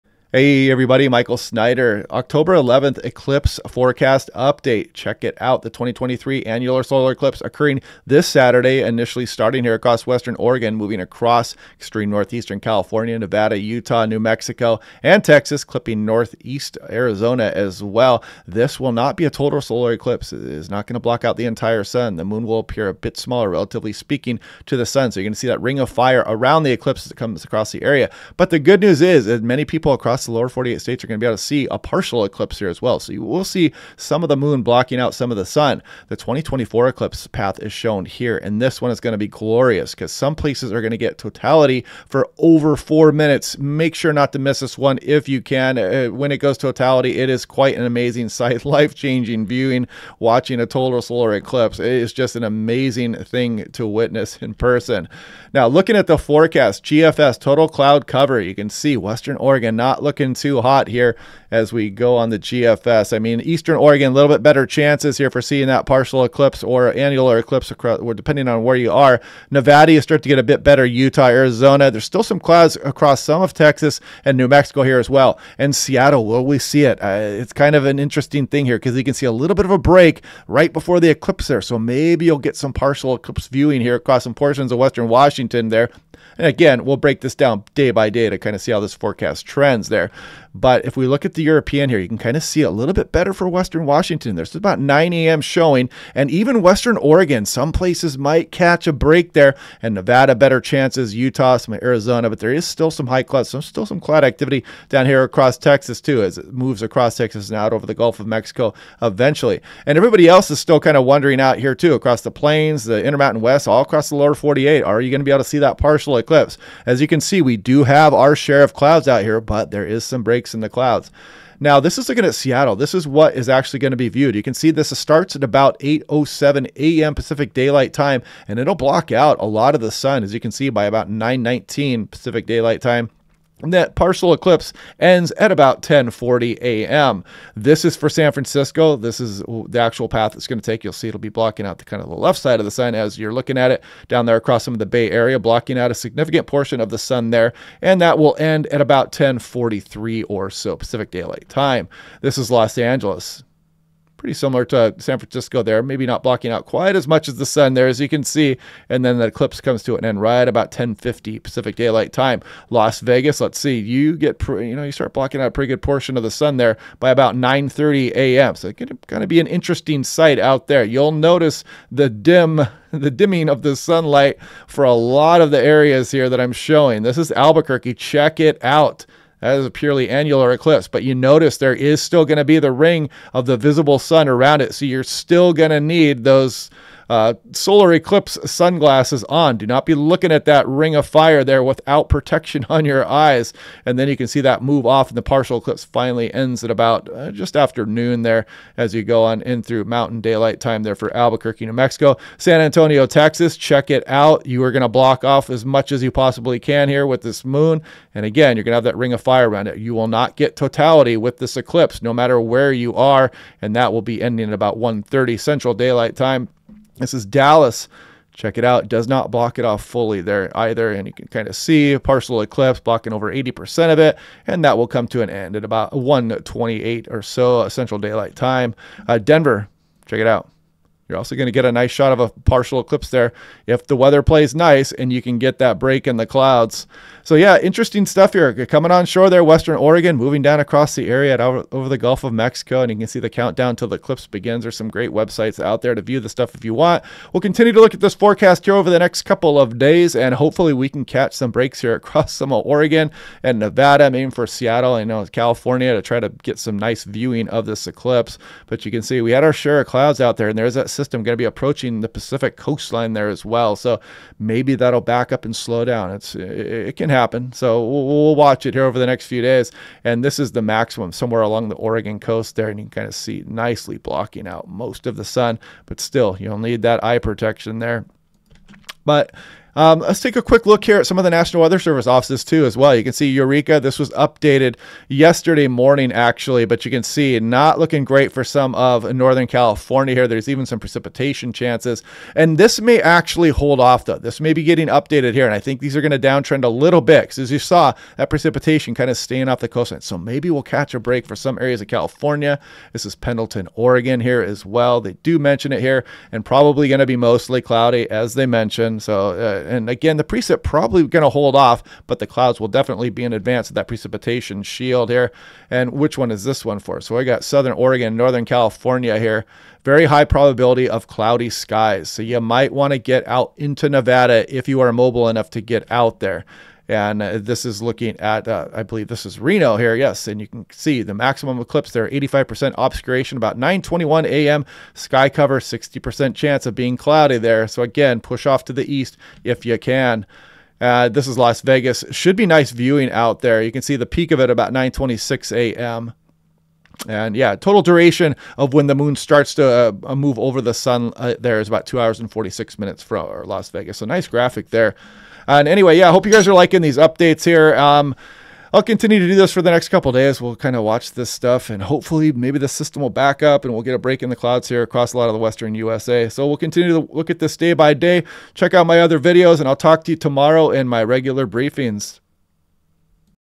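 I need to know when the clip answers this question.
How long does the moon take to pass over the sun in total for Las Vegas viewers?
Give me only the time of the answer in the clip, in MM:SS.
05:51.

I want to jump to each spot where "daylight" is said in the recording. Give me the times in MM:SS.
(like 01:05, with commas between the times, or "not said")
02:07, 02:12, 02:31, 02:41, 03:20, 03:35, 03:47.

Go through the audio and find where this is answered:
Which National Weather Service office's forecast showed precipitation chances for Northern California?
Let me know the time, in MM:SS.
04:43.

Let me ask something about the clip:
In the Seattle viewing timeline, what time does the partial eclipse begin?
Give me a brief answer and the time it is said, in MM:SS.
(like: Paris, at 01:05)
8:07 a.m., at 02:05.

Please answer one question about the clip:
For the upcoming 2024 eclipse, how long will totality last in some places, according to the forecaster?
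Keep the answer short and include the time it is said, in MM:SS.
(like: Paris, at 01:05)
over 4 minutes, at 00:42.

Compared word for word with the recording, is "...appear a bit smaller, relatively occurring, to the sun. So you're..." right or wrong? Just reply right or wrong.
wrong.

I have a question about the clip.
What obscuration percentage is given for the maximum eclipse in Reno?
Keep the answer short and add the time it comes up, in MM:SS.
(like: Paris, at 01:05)
85%, at 05:32.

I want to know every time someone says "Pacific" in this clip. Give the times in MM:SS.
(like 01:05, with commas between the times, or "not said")
02:07, 02:12, 02:30, 02:41, 04:22.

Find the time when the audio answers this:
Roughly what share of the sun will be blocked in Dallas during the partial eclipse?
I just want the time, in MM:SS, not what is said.
03:43.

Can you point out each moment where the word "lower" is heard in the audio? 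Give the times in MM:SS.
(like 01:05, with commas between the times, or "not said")
00:30, 01:54.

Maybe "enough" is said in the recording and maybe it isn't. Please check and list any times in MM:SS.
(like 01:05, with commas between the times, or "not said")
05:25.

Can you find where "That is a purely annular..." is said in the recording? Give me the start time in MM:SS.
02:59.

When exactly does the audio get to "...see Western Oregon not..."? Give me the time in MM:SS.
00:58.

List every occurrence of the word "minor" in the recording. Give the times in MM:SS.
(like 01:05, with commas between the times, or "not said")
not said.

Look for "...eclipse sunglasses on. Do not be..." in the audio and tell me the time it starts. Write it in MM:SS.
03:07.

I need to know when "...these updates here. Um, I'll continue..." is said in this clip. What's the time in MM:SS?
05:56.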